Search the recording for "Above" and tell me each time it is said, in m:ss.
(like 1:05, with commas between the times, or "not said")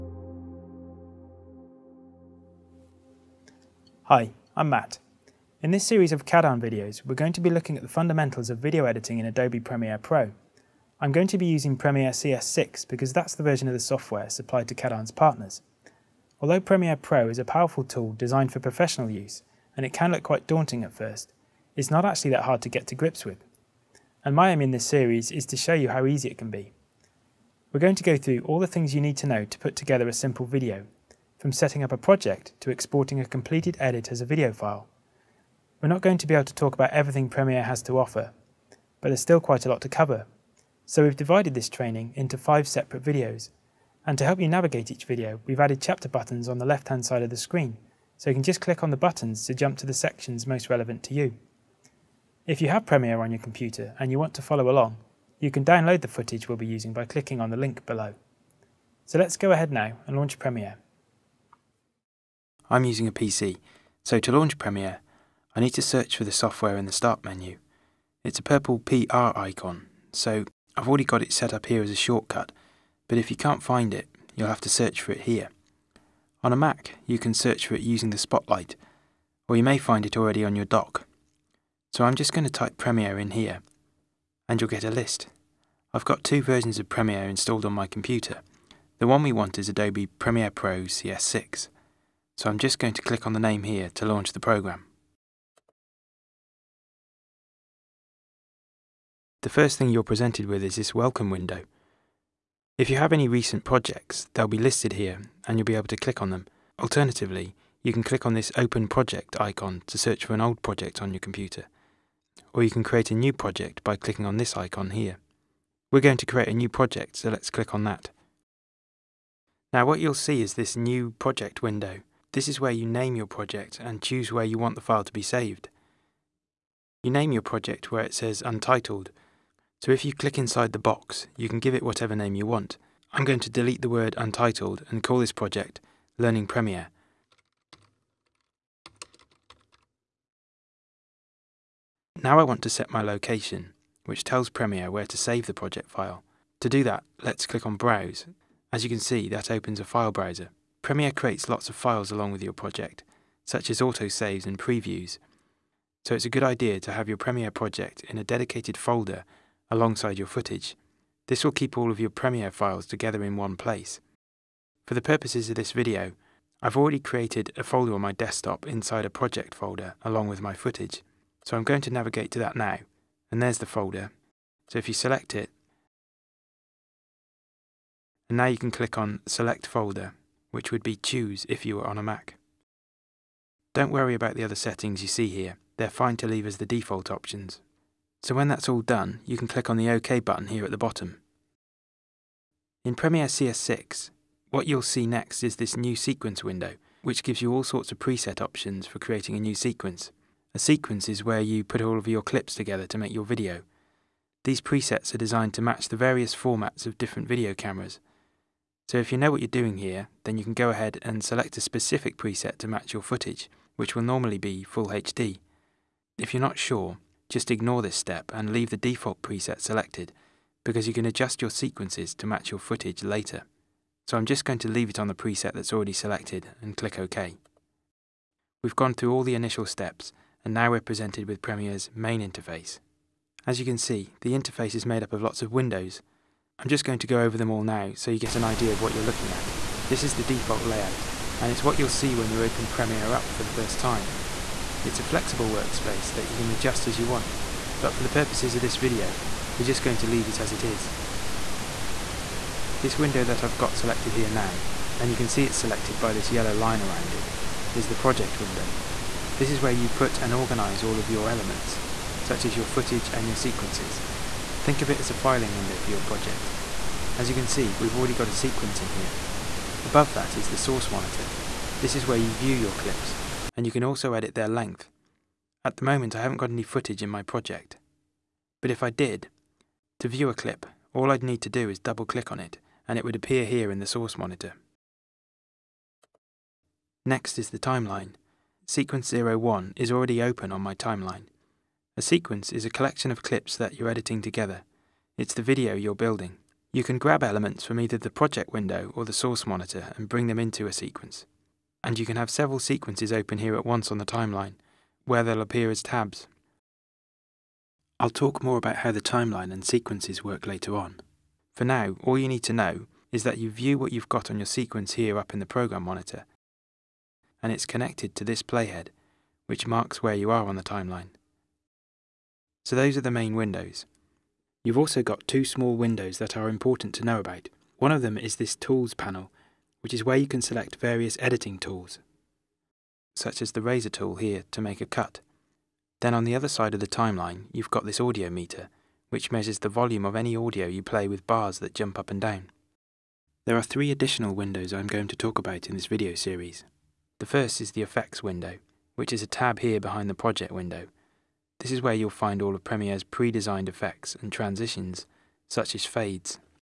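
4:29.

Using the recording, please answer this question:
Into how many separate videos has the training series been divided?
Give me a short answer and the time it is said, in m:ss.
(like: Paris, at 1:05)
5, at 0:42.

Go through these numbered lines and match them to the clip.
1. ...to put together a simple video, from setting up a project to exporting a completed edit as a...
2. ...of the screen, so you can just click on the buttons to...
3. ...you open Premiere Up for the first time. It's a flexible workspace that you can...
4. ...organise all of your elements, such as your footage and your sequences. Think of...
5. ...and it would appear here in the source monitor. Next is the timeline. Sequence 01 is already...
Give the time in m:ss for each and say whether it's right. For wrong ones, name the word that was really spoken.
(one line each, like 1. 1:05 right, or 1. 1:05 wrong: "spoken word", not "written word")
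1. 0:29 right
2. 0:47 right
3. 4:02 right
4. 4:20 right
5. 4:42 right.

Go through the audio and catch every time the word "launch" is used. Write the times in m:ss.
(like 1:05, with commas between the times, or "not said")
1:00, 1:04, 1:34.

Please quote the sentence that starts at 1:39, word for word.
The first thing you're presented with is this welcome window.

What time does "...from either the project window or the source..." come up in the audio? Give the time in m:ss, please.
4:57.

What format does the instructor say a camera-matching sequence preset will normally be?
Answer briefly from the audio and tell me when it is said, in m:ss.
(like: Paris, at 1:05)
Full HD, at 3:34.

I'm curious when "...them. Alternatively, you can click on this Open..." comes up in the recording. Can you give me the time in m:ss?
1:46.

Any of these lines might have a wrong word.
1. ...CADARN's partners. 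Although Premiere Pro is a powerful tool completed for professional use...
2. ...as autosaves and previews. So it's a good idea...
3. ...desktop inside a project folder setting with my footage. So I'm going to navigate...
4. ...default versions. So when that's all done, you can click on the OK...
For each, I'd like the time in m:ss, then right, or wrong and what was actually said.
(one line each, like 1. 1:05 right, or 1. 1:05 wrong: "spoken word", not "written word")
1. 0:14 wrong: "designed", not "completed"
2. 2:33 right
3. 2:48 wrong: "along", not "setting"
4. 3:06 wrong: "options", not "versions".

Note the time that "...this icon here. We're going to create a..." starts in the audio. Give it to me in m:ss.
1:54.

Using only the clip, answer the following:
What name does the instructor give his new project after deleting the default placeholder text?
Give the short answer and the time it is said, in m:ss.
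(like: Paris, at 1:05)
Learning Premiere, at 2:16.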